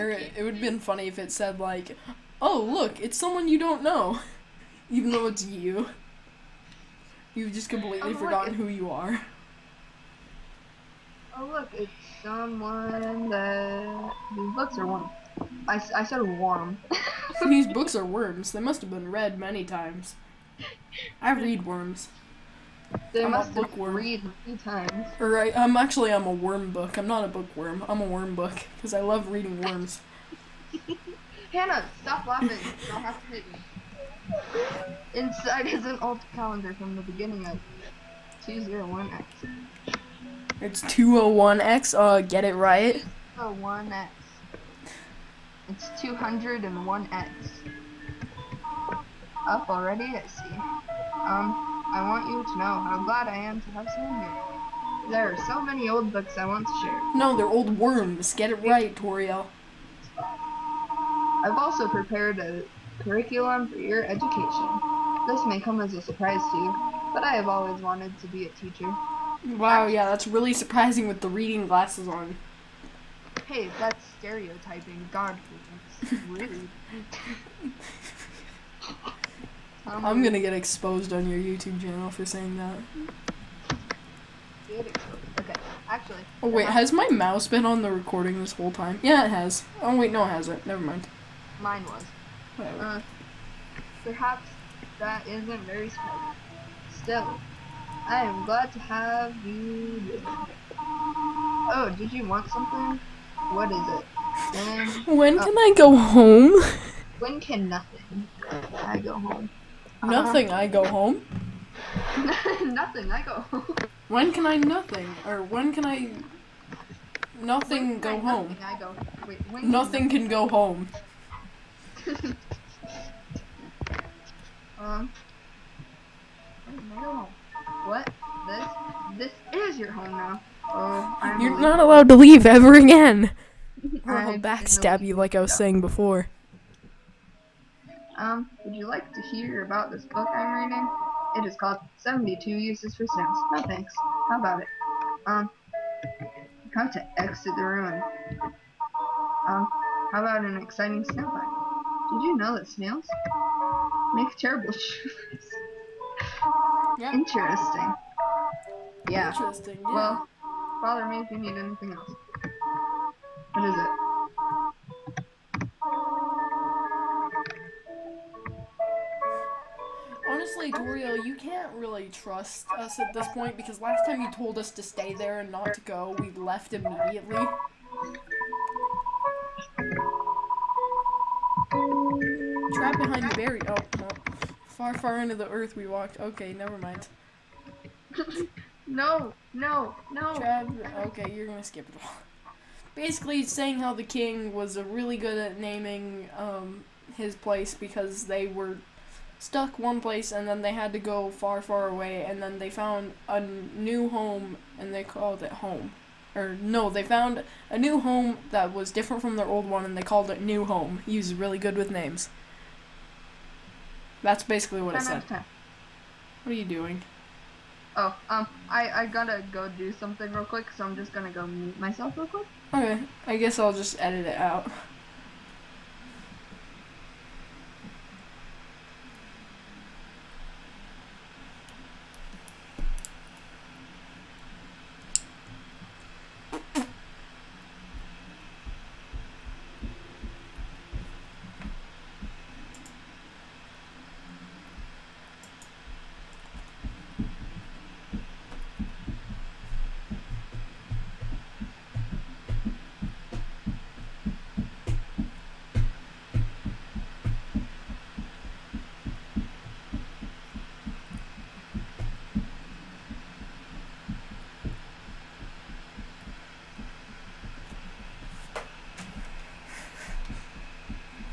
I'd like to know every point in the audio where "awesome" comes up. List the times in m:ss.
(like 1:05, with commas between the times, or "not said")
not said.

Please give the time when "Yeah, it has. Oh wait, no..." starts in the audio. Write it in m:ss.
1:29.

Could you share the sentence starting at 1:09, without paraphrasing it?
Wow, yeah, that's really surprising with the reading glasses on.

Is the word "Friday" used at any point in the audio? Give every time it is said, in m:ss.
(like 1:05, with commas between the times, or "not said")
not said.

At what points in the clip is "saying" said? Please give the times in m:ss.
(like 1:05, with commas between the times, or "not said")
1:22, 2:15, 3:13.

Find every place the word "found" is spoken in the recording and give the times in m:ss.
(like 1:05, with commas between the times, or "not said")
3:22, 3:27.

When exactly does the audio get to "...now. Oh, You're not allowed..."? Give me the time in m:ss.
2:10.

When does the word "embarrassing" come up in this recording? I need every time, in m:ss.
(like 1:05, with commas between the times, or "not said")
not said.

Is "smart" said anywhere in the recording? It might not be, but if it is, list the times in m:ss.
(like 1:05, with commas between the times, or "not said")
1:35.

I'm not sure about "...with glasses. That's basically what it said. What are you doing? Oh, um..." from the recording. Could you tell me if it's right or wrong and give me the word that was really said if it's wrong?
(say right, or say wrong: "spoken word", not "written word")
wrong: "names", not "glasses".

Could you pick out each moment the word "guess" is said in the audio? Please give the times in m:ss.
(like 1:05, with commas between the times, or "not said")
3:43.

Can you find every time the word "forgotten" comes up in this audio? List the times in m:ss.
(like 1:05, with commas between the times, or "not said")
0:08.